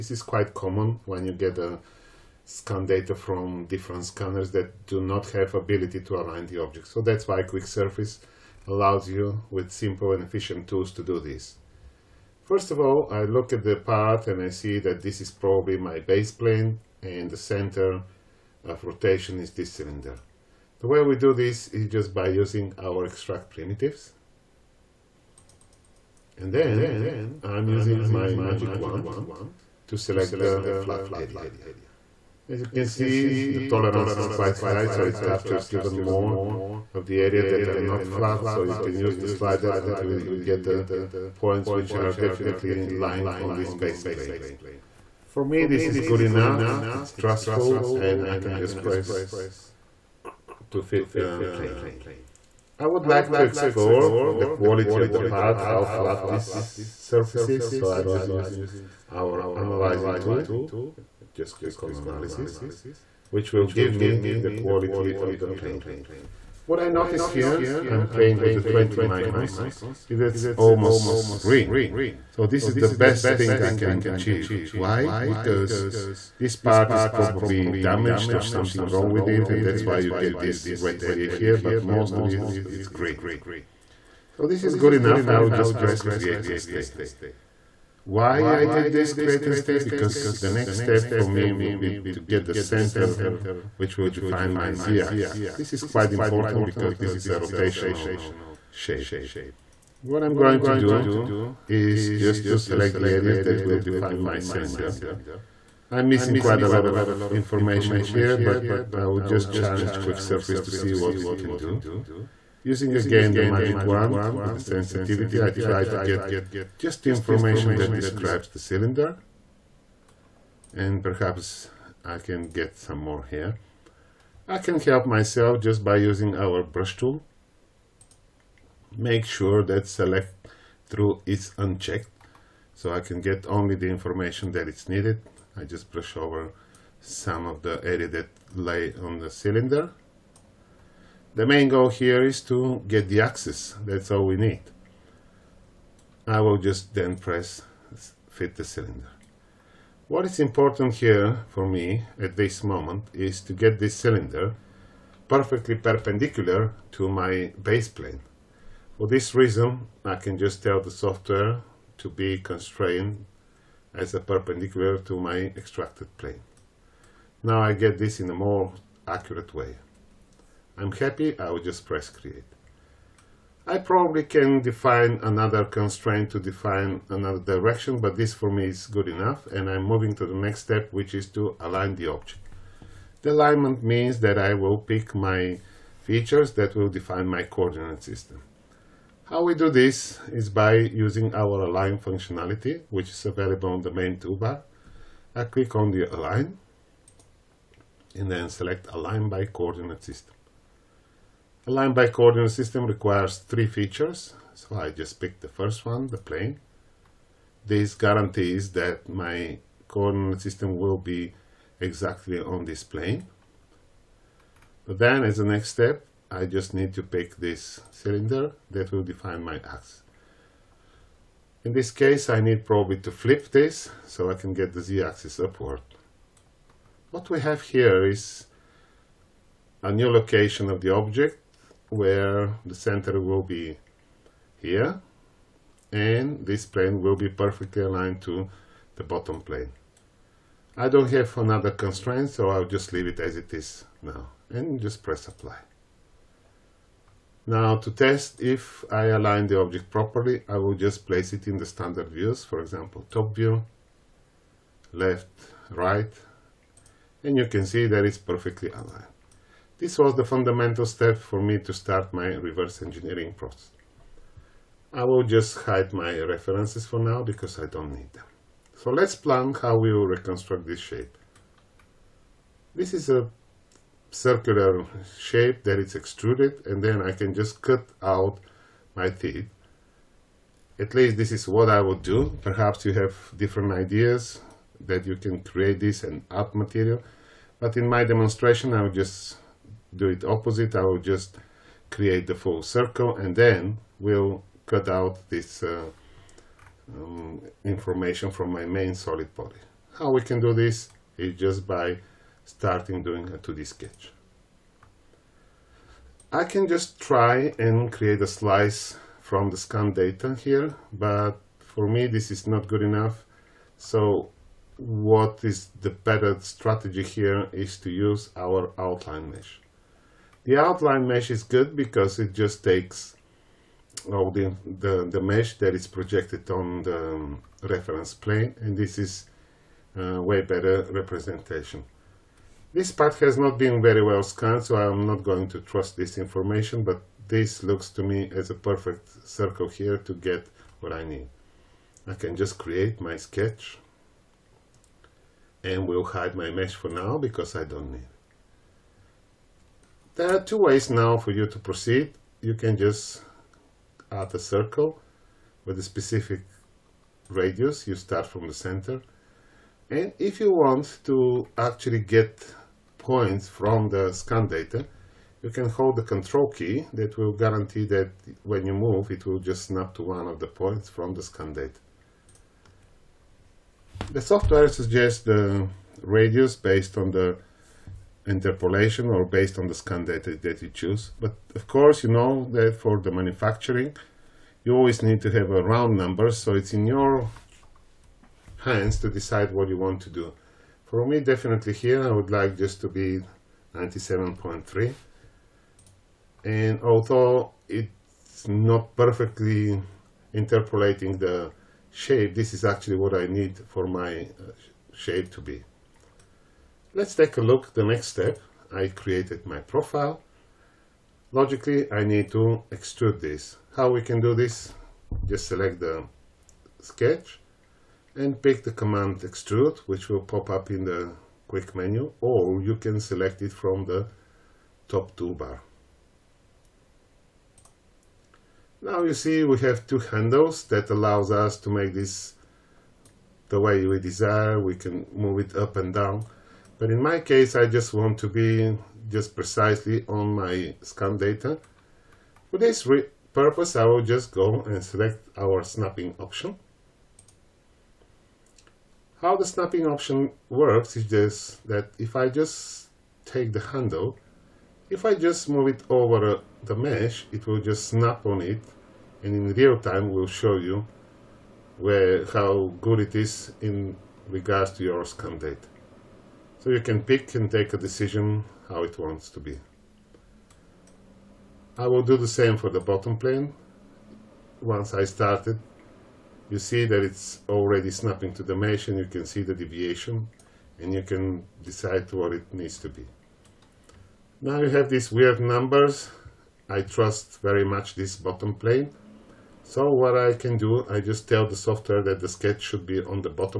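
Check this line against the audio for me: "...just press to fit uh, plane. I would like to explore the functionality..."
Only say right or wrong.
wrong.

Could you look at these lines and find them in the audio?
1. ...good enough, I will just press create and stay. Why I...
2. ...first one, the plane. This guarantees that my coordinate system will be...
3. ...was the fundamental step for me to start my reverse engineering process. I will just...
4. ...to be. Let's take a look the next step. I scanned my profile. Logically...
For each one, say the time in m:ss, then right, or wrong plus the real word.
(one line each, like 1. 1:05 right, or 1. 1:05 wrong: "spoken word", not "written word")
1. 1:24 right
2. 3:25 right
3. 4:19 right
4. 6:45 wrong: "created", not "scanned".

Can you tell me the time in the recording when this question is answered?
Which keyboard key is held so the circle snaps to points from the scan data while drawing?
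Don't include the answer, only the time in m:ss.
6:06.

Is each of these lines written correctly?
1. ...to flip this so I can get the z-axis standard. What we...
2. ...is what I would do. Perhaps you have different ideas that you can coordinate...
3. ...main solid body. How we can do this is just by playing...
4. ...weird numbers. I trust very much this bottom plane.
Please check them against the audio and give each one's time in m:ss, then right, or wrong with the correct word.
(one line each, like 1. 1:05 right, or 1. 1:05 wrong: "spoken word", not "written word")
1. 3:43 wrong: "upward", not "standard"
2. 4:41 wrong: "create", not "coordinate"
3. 4:58 wrong: "starting", not "playing"
4. 8:05 right.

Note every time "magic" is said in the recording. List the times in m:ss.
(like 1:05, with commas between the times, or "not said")
0:28, 1:53.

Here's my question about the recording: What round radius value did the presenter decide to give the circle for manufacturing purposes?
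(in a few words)
97.3.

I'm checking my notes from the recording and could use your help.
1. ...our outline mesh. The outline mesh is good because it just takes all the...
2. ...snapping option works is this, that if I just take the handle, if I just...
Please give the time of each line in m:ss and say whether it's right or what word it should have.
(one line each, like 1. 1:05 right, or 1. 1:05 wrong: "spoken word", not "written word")
1. 5:18 right
2. 7:29 right.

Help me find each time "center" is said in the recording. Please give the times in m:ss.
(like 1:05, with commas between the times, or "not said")
0:17, 1:32, 3:52, 5:58.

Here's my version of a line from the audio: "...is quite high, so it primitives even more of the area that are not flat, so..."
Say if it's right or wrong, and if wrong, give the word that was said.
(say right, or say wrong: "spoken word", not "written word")
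wrong: "captures", not "primitives".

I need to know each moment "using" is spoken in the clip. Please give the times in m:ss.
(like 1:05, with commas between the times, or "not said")
0:22, 0:27, 0:58, 1:52, 2:05, 3:10.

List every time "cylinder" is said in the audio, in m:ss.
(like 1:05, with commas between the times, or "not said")
0:19, 1:44, 1:58, 2:19, 2:28, 2:33, 3:37.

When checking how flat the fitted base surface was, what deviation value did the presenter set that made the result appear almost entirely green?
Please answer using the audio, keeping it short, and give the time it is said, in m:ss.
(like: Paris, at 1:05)
20 microns, at 1:08.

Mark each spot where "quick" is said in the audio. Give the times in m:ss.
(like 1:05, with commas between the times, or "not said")
0:07, 1:49, 7:01.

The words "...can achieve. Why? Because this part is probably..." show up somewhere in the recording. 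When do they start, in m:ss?
1:13.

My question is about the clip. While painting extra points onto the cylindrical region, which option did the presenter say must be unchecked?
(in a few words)
select through.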